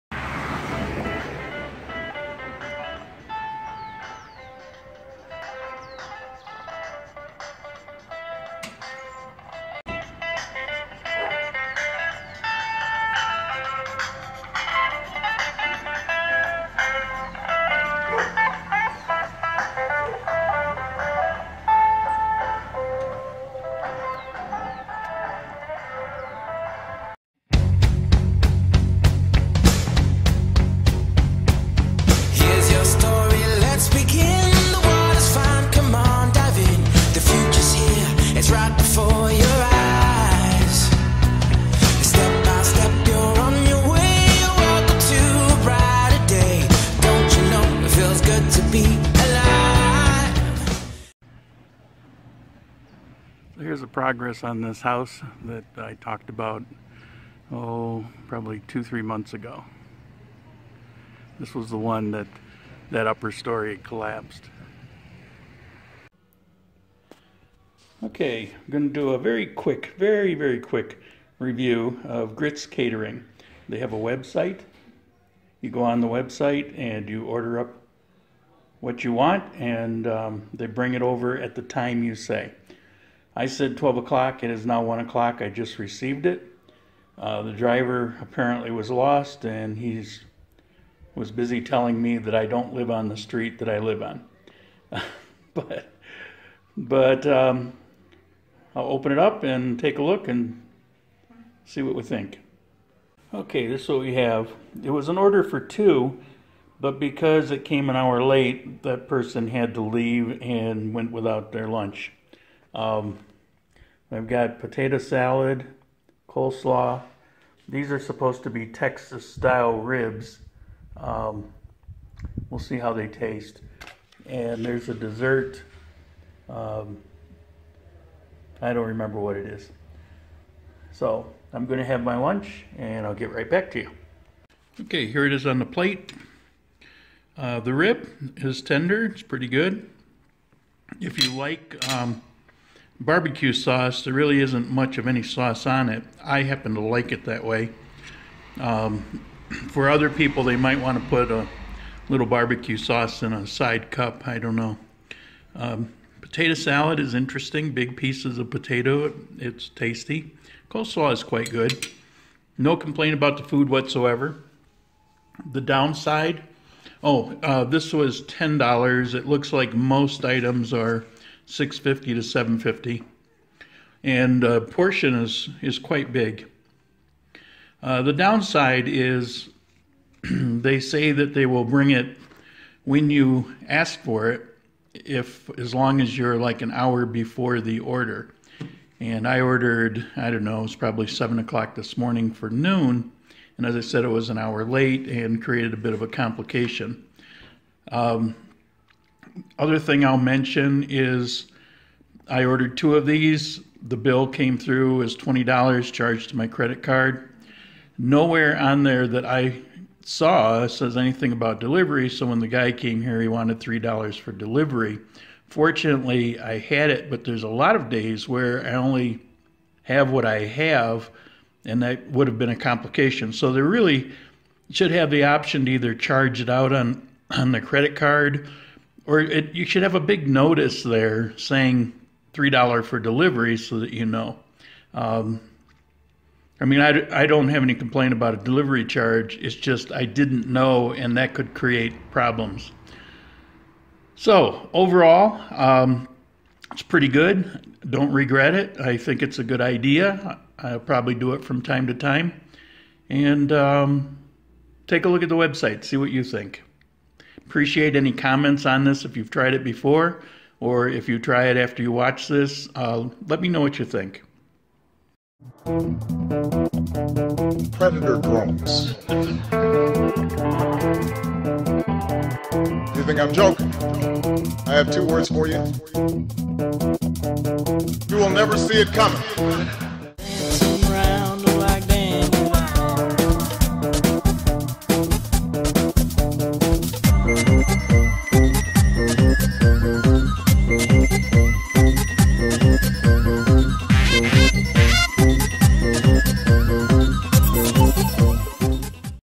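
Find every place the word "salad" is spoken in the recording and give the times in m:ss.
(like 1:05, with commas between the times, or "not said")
1:54, 2:36.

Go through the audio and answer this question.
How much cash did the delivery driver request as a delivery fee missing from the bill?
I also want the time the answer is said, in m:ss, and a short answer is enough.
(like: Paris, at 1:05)
$3, at 3:33.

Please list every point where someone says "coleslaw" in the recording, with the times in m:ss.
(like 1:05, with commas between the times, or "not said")
1:56, 2:40.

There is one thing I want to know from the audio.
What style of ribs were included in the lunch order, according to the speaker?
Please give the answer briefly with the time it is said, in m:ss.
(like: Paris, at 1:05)
Texas style, at 1:58.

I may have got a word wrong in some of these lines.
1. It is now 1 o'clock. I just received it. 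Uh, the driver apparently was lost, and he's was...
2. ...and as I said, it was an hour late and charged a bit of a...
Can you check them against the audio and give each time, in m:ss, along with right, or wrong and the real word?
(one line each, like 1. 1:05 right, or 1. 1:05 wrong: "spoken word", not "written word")
1. 1:24 right
2. 3:13 wrong: "created", not "charged".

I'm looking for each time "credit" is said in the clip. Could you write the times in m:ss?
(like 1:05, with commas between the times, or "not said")
3:26, 3:47.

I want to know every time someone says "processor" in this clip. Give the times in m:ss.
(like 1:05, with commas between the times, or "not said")
not said.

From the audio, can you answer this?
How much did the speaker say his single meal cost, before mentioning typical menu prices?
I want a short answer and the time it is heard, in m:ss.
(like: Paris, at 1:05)
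$10, at 2:48.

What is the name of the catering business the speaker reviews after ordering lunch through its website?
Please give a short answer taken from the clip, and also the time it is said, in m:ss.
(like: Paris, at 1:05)
Grits Catering, at 1:12.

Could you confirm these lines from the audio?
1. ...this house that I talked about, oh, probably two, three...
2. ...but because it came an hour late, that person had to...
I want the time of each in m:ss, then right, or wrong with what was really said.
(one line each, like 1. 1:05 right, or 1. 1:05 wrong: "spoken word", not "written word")
1. 0:54 right
2. 1:46 right.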